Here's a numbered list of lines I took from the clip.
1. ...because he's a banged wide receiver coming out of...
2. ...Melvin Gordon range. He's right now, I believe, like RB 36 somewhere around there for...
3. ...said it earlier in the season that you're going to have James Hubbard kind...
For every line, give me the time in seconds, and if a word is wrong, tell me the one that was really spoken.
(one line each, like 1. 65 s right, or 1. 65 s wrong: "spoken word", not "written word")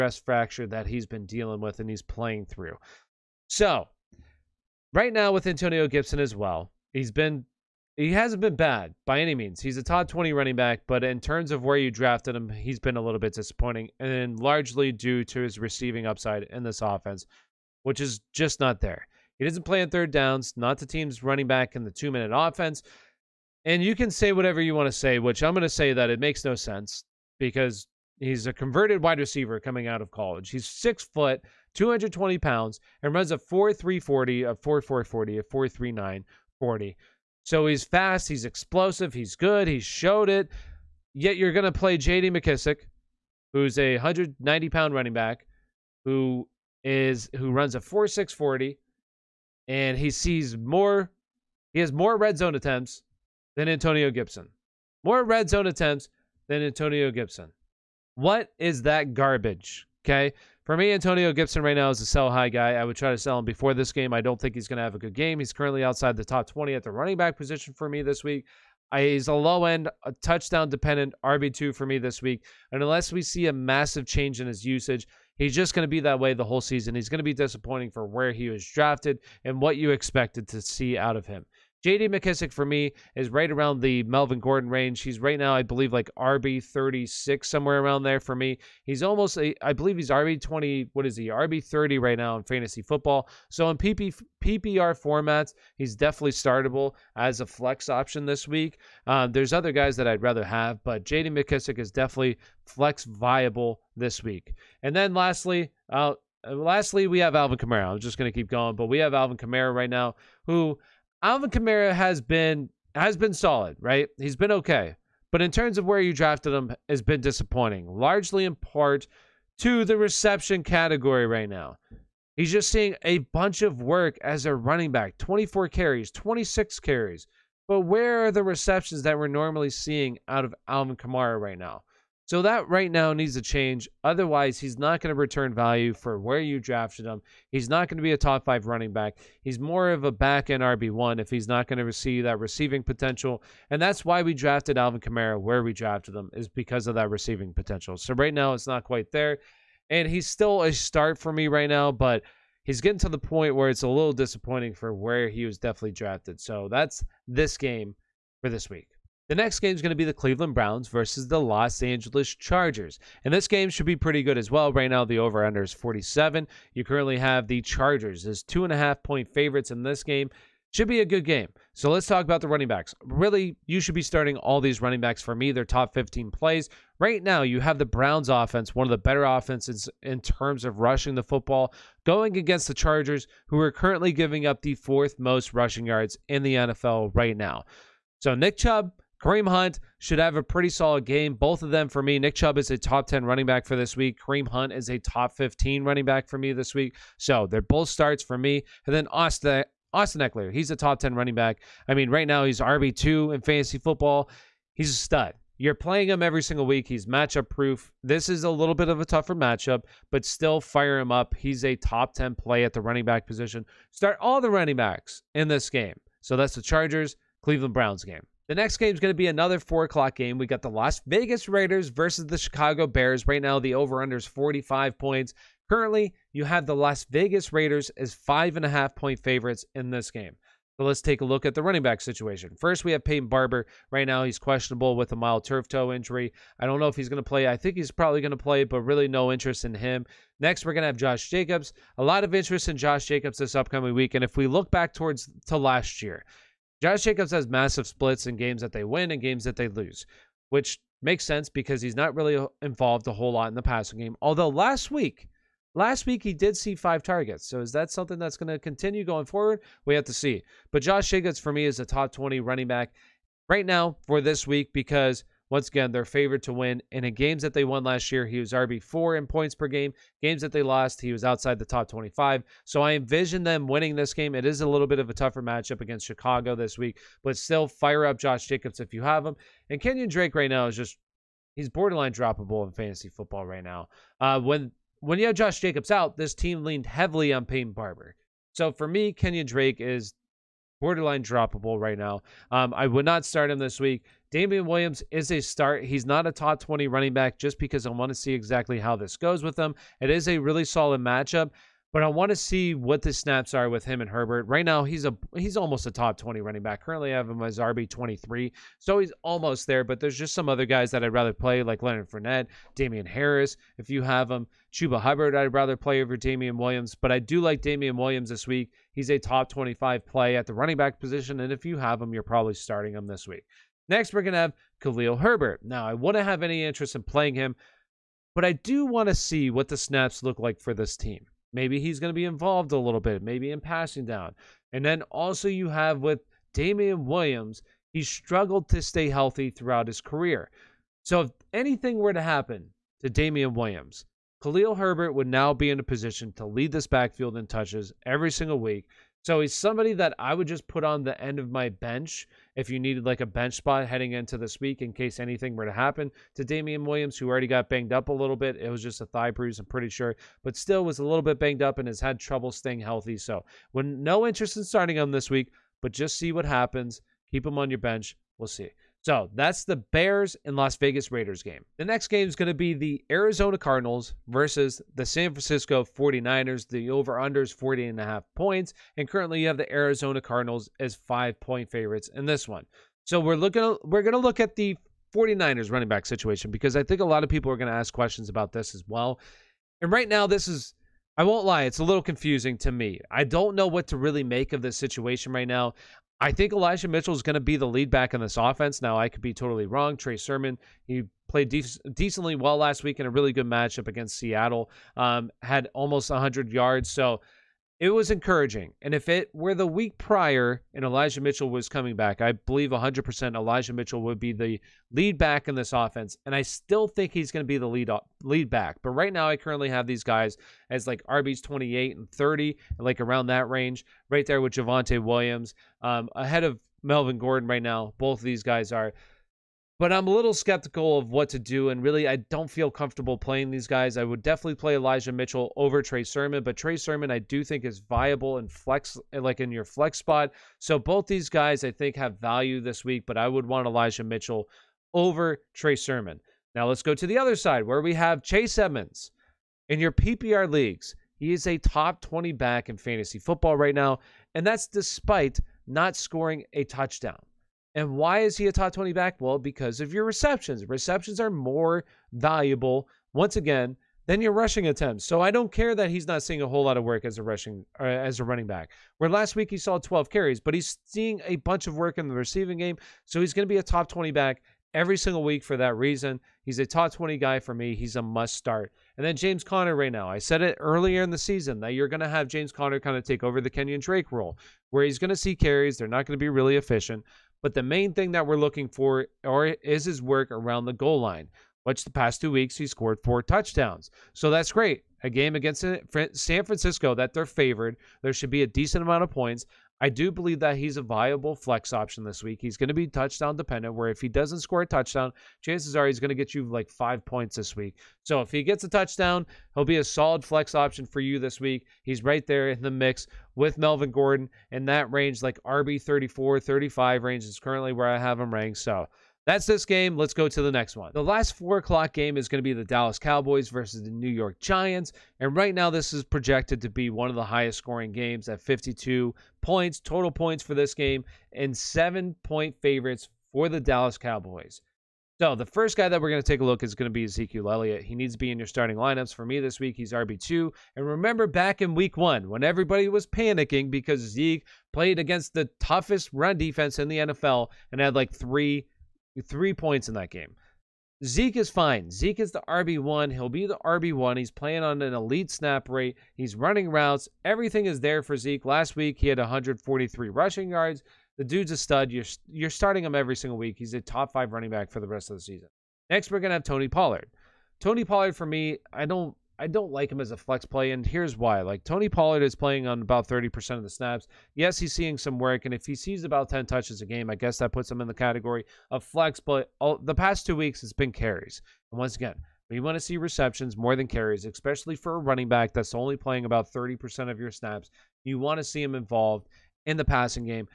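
1. 27 s wrong: "converted", not "banged"
2. 84 s right
3. 480 s wrong: "Conner", not "Hubbard".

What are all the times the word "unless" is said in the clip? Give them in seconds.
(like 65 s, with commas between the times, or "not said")
72 s.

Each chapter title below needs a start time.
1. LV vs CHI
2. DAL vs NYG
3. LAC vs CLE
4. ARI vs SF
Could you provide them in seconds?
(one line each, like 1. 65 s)
1. 217 s
2. 519 s
3. 158 s
4. 370 s.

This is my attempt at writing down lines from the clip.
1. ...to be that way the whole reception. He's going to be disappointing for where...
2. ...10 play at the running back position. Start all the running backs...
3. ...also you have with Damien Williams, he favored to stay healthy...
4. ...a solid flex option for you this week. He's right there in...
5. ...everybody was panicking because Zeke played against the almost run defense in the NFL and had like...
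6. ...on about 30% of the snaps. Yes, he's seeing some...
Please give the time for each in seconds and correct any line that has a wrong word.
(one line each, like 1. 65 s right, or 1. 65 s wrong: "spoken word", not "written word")
1. 75 s wrong: "season", not "reception"
2. 212 s right
3. 335 s wrong: "struggled", not "favored"
4. 509 s right
5. 542 s wrong: "toughest", not "almost"
6. 572 s right.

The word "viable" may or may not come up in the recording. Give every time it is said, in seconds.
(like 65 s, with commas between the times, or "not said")
103 s, 437 s, 500 s.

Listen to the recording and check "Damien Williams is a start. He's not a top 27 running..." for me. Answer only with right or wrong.
wrong.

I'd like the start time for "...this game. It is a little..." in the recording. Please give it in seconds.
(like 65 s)
273 s.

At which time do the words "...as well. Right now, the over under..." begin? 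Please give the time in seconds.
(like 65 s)
164 s.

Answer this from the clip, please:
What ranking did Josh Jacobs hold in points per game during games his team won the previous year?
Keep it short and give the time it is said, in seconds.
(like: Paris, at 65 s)
RB4, at 268 s.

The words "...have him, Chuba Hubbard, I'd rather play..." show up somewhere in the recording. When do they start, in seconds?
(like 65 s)
314 s.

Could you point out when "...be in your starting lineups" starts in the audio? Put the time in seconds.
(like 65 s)
538 s.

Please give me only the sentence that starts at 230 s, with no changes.
So let's take a look at the running back situation.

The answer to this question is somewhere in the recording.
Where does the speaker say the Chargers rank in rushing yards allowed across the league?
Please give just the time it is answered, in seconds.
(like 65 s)
184 s.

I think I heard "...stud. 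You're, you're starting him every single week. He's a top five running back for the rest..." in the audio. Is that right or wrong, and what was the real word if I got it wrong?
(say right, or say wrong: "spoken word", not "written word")
right.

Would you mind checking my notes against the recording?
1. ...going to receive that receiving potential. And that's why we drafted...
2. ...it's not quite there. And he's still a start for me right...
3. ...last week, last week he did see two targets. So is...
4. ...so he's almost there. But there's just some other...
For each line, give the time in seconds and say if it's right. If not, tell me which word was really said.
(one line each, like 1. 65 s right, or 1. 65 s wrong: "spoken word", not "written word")
1. 141 s right
2. 148 s right
3. 254 s wrong: "five", not "two"
4. 308 s right.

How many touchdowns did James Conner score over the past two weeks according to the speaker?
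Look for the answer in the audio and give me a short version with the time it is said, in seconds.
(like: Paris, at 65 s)
4, at 492 s.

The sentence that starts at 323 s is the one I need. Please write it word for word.
Next, we're gonna have Khalil Herbert.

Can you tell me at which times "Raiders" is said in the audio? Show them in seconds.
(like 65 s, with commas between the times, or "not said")
221 s, 227 s, 371 s.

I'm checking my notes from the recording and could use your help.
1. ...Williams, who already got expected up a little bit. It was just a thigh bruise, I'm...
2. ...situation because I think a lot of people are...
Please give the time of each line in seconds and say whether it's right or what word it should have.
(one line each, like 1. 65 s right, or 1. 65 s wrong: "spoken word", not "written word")
1. 356 s wrong: "banged", not "expected"
2. 386 s right.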